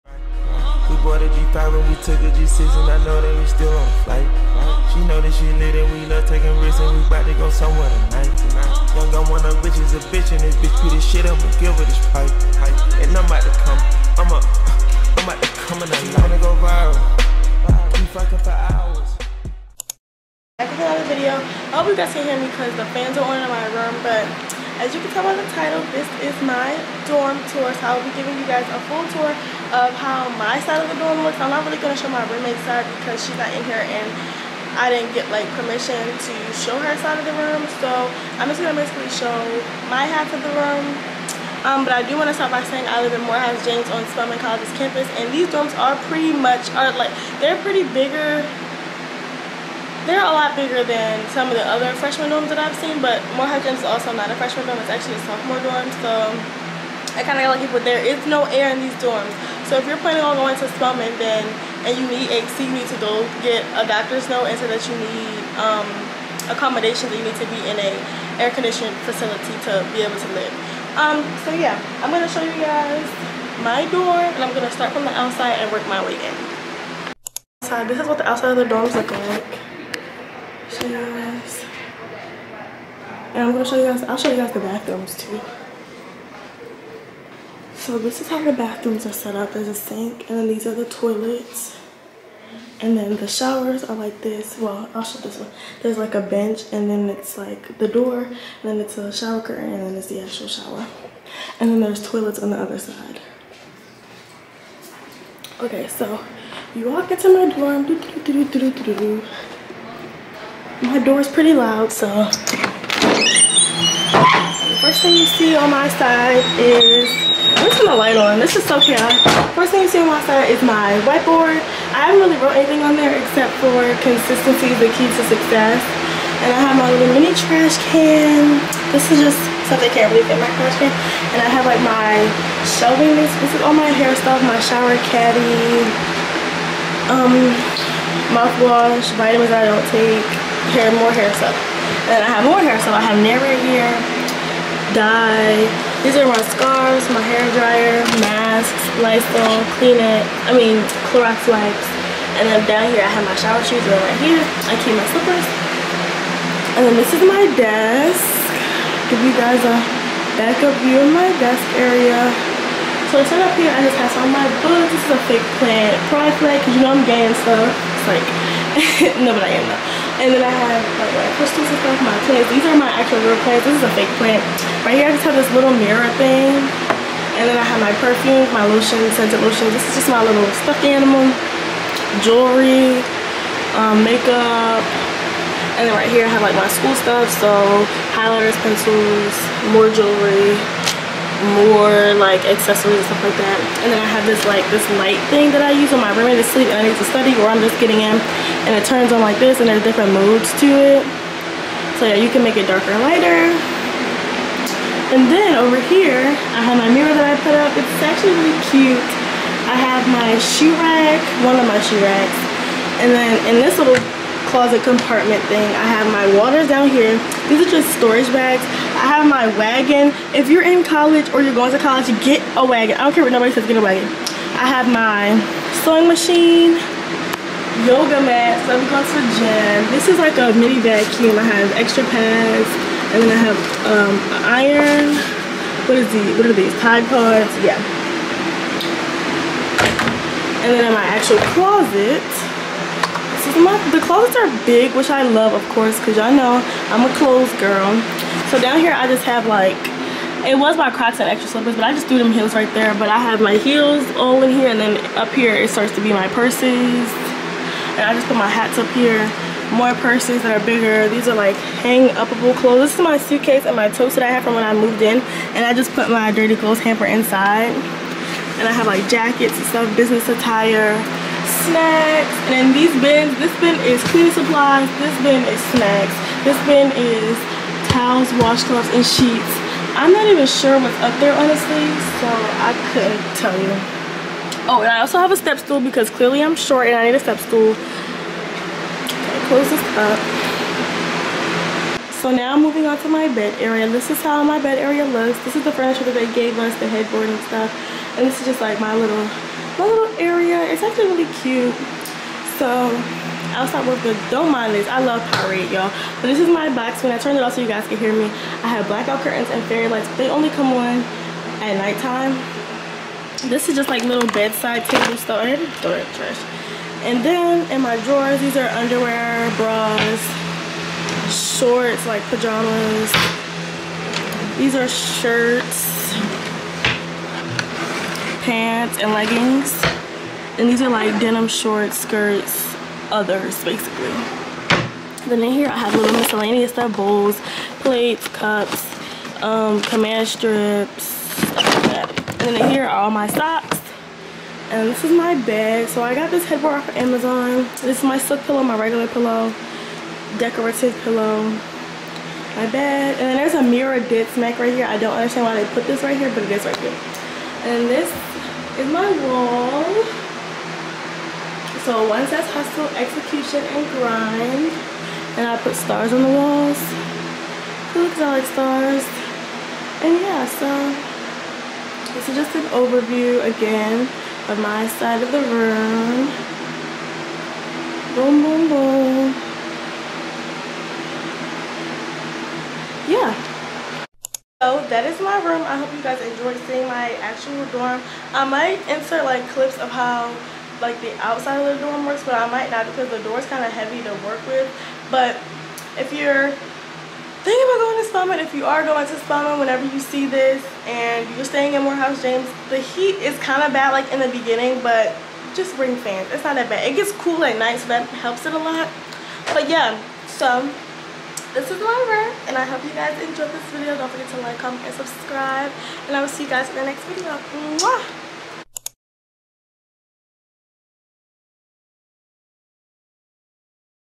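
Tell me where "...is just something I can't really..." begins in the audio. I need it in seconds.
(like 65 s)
129 s.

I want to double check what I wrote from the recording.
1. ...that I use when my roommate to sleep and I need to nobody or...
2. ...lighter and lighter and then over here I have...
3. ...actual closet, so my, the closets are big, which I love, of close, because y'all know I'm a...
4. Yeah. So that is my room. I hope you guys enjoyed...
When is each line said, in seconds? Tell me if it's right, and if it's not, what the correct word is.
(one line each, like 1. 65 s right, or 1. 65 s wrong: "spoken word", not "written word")
1. 195 s wrong: "study", not "nobody"
2. 202 s wrong: "darker", not "lighter"
3. 241 s wrong: "course", not "close"
4. 383 s right.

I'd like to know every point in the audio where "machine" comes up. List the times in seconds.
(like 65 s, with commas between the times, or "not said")
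226 s.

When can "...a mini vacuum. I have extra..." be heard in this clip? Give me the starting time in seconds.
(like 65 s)
230 s.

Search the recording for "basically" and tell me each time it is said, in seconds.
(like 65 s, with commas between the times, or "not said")
38 s, 333 s.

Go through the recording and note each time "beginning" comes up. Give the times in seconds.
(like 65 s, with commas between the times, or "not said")
404 s.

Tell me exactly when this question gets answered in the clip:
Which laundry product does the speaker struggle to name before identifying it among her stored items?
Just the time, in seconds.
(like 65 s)
236 s.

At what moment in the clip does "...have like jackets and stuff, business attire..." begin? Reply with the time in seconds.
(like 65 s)
268 s.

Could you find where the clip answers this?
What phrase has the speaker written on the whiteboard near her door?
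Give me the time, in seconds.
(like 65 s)
124 s.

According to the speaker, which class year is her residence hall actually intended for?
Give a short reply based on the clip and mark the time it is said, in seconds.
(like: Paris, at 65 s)
Sophomore, at 55 s.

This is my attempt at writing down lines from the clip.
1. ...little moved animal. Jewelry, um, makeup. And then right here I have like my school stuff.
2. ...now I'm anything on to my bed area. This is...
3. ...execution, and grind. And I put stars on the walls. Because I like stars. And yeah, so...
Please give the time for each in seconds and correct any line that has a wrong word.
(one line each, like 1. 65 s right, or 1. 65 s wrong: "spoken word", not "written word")
1. 180 s wrong: "stuffed", not "moved"
2. 292 s wrong: "moving", not "anything"
3. 362 s right.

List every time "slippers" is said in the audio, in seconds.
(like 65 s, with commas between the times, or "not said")
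155 s, 251 s.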